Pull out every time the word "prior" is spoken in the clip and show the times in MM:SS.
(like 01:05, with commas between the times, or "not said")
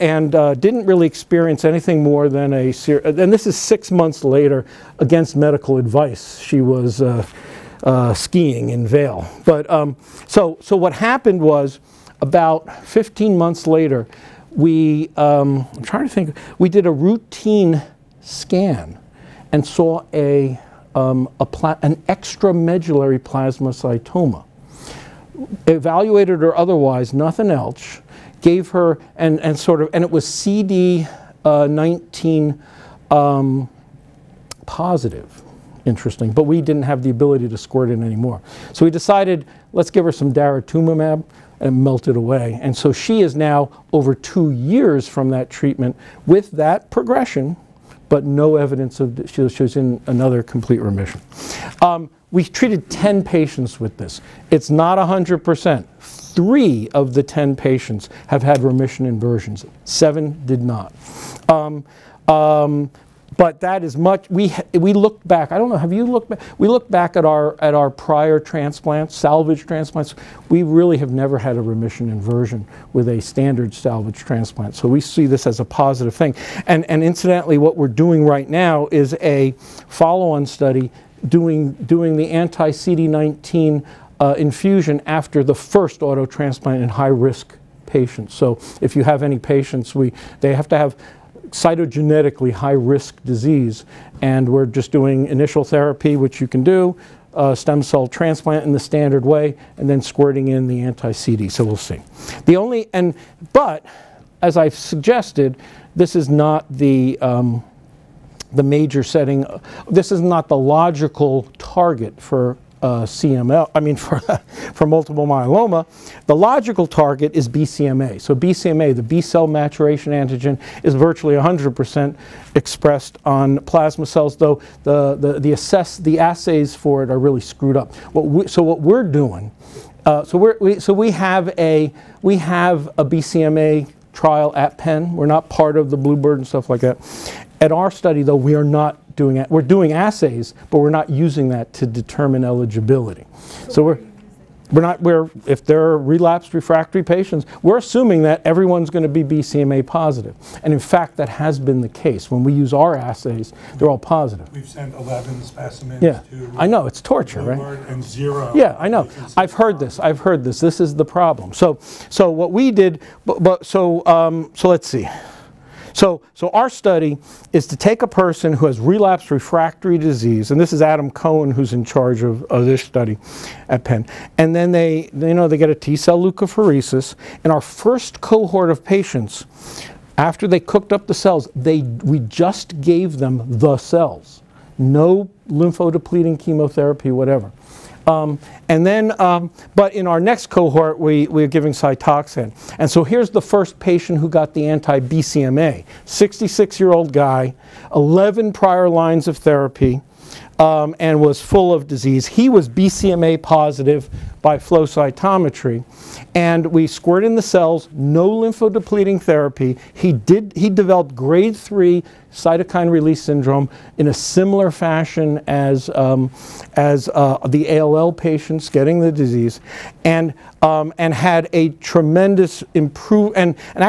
01:07, 03:18.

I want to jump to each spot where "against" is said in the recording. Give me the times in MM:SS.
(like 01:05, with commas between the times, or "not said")
00:04.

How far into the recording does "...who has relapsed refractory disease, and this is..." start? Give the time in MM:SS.
02:48.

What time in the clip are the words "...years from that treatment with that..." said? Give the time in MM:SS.
00:44.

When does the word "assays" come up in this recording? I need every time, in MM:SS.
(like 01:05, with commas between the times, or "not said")
02:06, 02:19, 02:32.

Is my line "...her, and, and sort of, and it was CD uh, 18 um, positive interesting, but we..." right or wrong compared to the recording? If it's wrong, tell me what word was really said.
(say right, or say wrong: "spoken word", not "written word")
wrong: "19", not "18".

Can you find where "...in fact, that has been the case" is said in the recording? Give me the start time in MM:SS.
02:30.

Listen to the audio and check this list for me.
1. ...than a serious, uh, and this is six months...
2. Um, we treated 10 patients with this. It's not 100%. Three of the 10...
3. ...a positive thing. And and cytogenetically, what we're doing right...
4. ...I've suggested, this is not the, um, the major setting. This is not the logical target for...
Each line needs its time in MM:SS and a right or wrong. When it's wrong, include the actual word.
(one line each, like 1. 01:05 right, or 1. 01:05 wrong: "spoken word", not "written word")
1. 00:02 right
2. 00:51 right
3. 01:15 wrong: "incidentally", not "cytogenetically"
4. 01:44 right.